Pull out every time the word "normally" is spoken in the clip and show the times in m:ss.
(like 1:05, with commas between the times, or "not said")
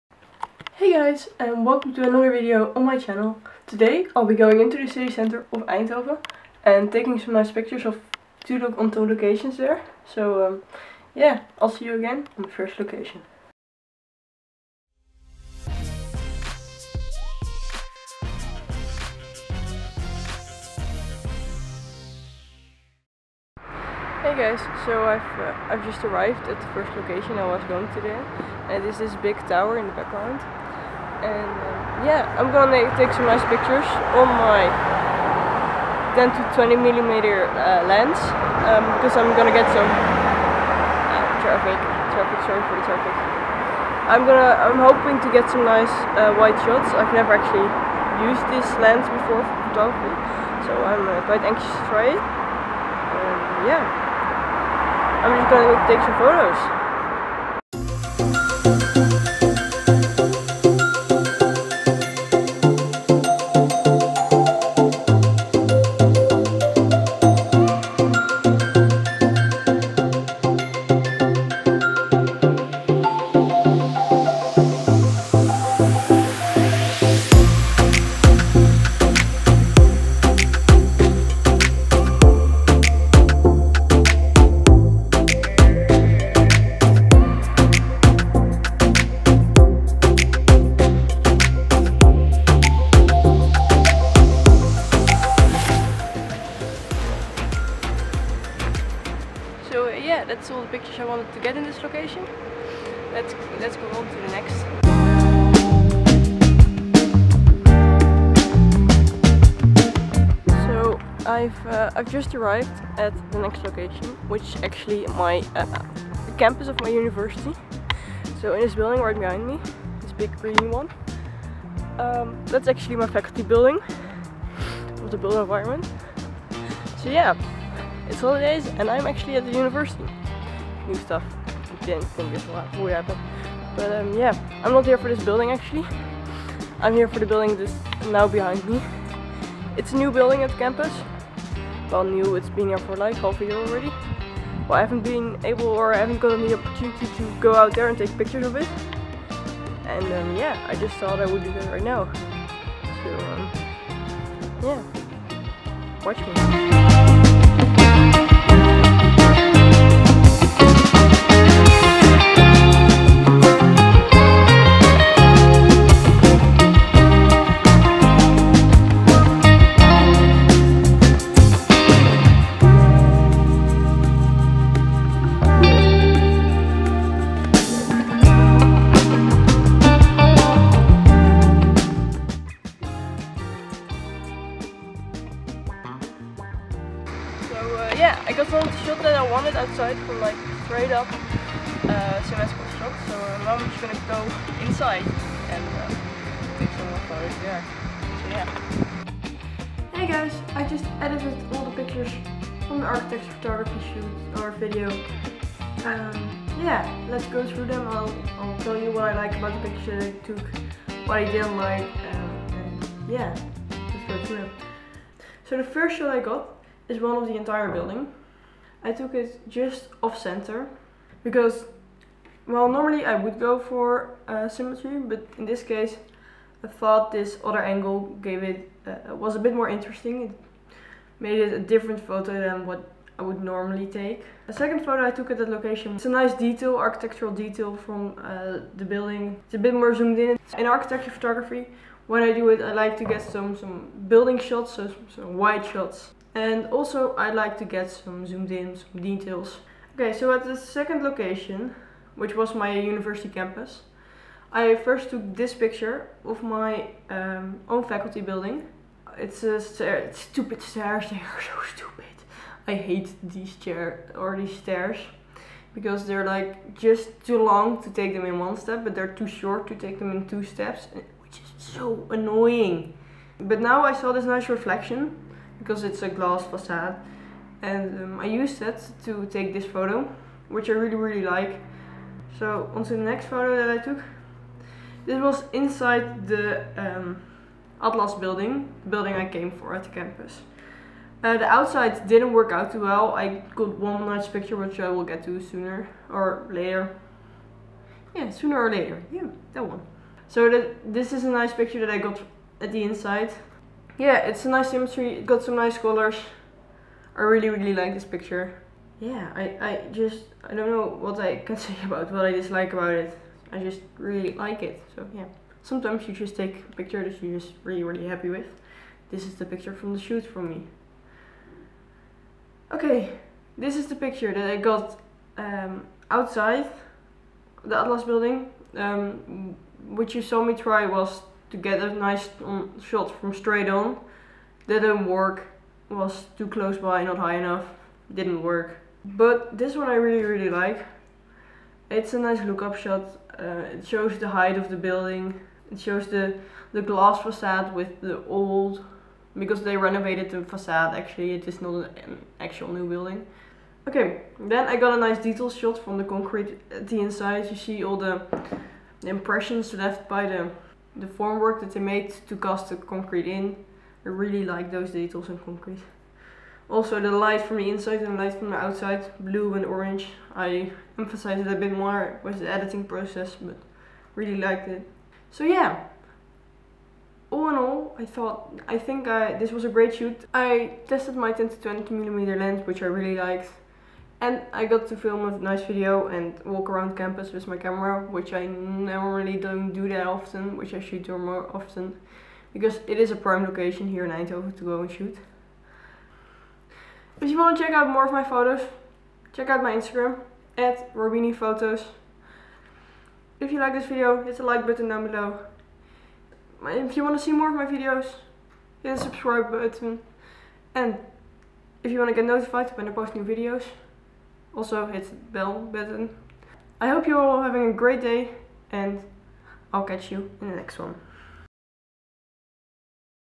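3:42, 3:53, 6:28.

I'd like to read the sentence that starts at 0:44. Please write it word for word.
I'm gonna, I'm hoping to get some nice uh, wide shots.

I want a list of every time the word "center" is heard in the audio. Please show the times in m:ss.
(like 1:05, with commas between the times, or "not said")
0:05, 3:40.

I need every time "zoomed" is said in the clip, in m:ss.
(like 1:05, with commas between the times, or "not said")
3:59, 4:08.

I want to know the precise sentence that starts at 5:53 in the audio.
Okay, then I got a nice detail shot from the concrete at the inside.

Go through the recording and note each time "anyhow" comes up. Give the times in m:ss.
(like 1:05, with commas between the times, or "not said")
not said.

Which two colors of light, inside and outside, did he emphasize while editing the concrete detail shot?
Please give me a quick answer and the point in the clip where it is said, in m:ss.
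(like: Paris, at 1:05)
Blue and orange, at 6:09.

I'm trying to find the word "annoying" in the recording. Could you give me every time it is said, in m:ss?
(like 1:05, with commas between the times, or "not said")
4:32.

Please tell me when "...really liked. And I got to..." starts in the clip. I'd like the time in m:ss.
6:22.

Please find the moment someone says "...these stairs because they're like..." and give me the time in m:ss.
4:24.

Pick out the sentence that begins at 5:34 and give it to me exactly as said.
Didn't work, was too close by, not high enough, didn't work.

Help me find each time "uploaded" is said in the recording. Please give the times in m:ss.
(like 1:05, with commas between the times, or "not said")
not said.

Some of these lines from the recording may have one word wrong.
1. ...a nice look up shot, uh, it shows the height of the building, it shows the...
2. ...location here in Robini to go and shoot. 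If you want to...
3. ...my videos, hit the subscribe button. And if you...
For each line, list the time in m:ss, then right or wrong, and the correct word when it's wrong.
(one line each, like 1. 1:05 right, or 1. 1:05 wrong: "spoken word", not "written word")
1. 5:42 right
2. 6:33 wrong: "Eindhoven", not "Robini"
3. 6:47 right.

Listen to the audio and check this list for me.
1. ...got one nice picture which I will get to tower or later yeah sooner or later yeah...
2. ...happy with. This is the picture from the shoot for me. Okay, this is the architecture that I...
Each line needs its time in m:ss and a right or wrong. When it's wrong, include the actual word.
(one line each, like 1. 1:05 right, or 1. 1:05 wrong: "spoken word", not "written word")
1. 4:53 wrong: "sooner", not "tower"
2. 5:18 wrong: "picture", not "architecture".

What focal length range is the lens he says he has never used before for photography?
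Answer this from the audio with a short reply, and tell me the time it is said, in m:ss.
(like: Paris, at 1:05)
10 to 20 millimeter, at 0:36.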